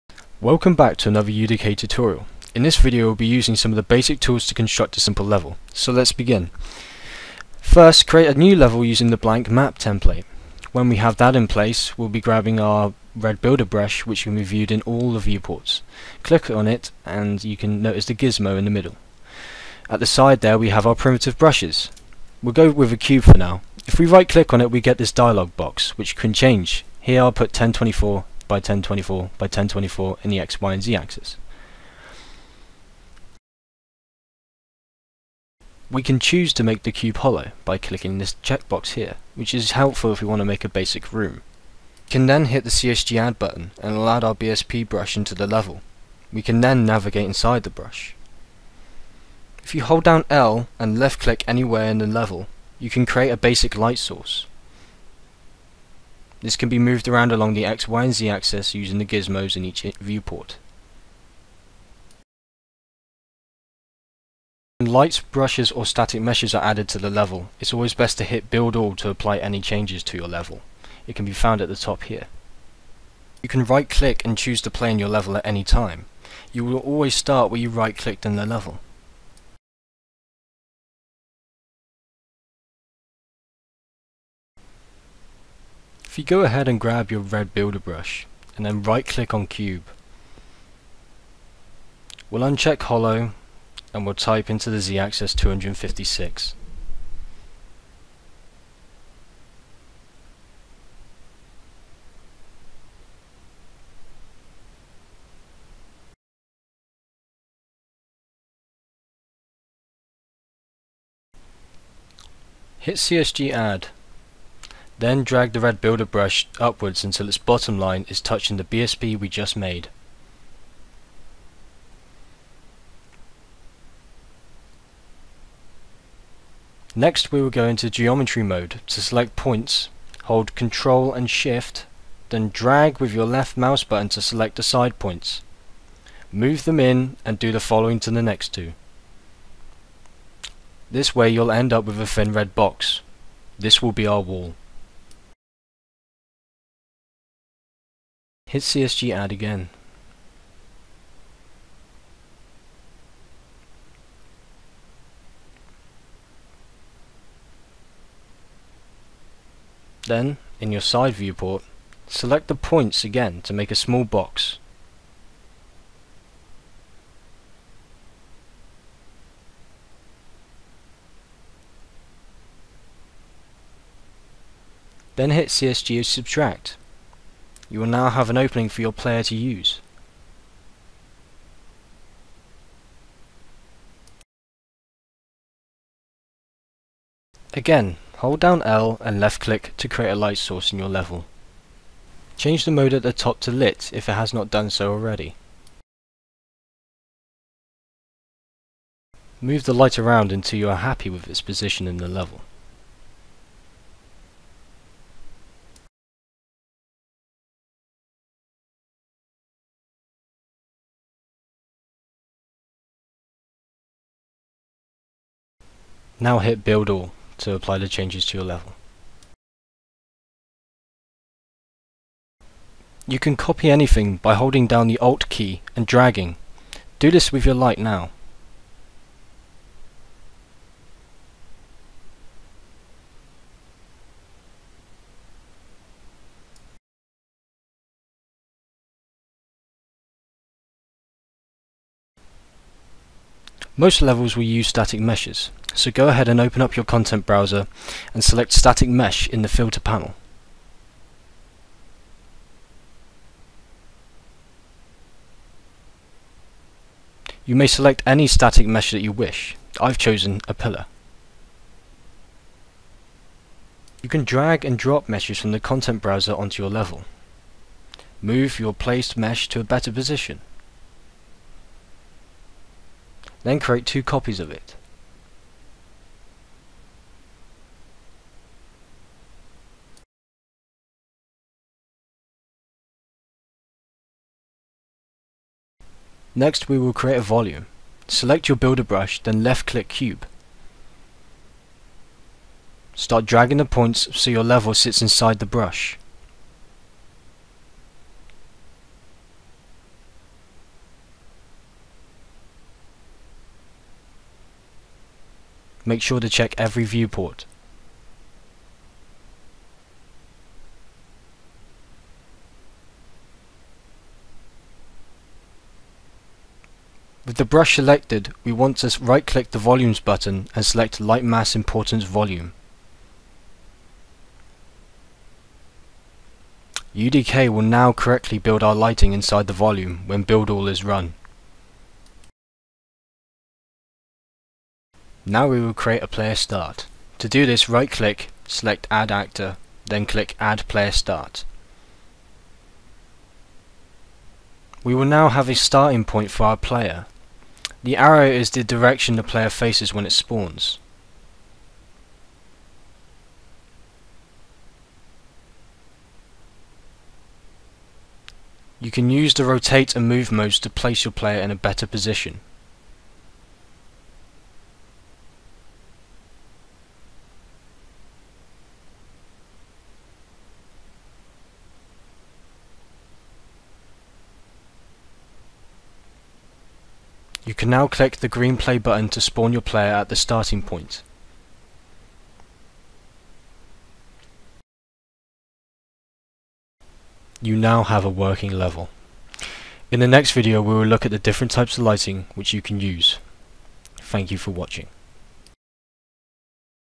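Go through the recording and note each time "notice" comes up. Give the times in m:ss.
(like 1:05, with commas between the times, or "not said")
0:17.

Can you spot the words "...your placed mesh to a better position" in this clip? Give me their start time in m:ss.
4:28.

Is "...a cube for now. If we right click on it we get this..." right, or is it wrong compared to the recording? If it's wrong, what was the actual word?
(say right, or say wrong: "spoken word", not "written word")
right.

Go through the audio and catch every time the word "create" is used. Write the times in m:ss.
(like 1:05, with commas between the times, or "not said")
0:08, 0:53, 3:09, 4:33, 4:46, 5:35.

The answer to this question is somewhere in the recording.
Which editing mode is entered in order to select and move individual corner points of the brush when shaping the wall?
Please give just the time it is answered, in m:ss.
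2:07.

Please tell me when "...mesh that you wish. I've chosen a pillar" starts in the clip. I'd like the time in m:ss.
4:18.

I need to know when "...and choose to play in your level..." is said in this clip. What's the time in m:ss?
1:14.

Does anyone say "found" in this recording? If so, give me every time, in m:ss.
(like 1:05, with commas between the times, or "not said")
1:11.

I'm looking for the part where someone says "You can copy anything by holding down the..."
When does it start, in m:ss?
3:43.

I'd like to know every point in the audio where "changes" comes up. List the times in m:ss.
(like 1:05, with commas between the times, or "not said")
0:26, 1:09, 3:12, 3:37.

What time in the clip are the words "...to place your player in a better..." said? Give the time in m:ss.
6:00.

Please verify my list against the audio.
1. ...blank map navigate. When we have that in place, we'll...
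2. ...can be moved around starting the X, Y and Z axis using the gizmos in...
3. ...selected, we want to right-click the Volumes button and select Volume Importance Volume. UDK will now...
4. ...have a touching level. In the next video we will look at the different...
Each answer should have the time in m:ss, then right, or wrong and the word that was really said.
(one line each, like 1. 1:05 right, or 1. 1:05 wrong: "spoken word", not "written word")
1. 0:09 wrong: "template", not "navigate"
2. 0:56 wrong: "along", not "starting"
3. 5:17 wrong: "Lightmass", not "Volume"
4. 6:27 wrong: "working", not "touching".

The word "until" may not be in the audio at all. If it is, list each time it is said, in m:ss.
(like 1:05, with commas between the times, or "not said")
1:57, 3:20.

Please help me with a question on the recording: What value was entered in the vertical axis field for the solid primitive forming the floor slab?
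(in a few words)
256.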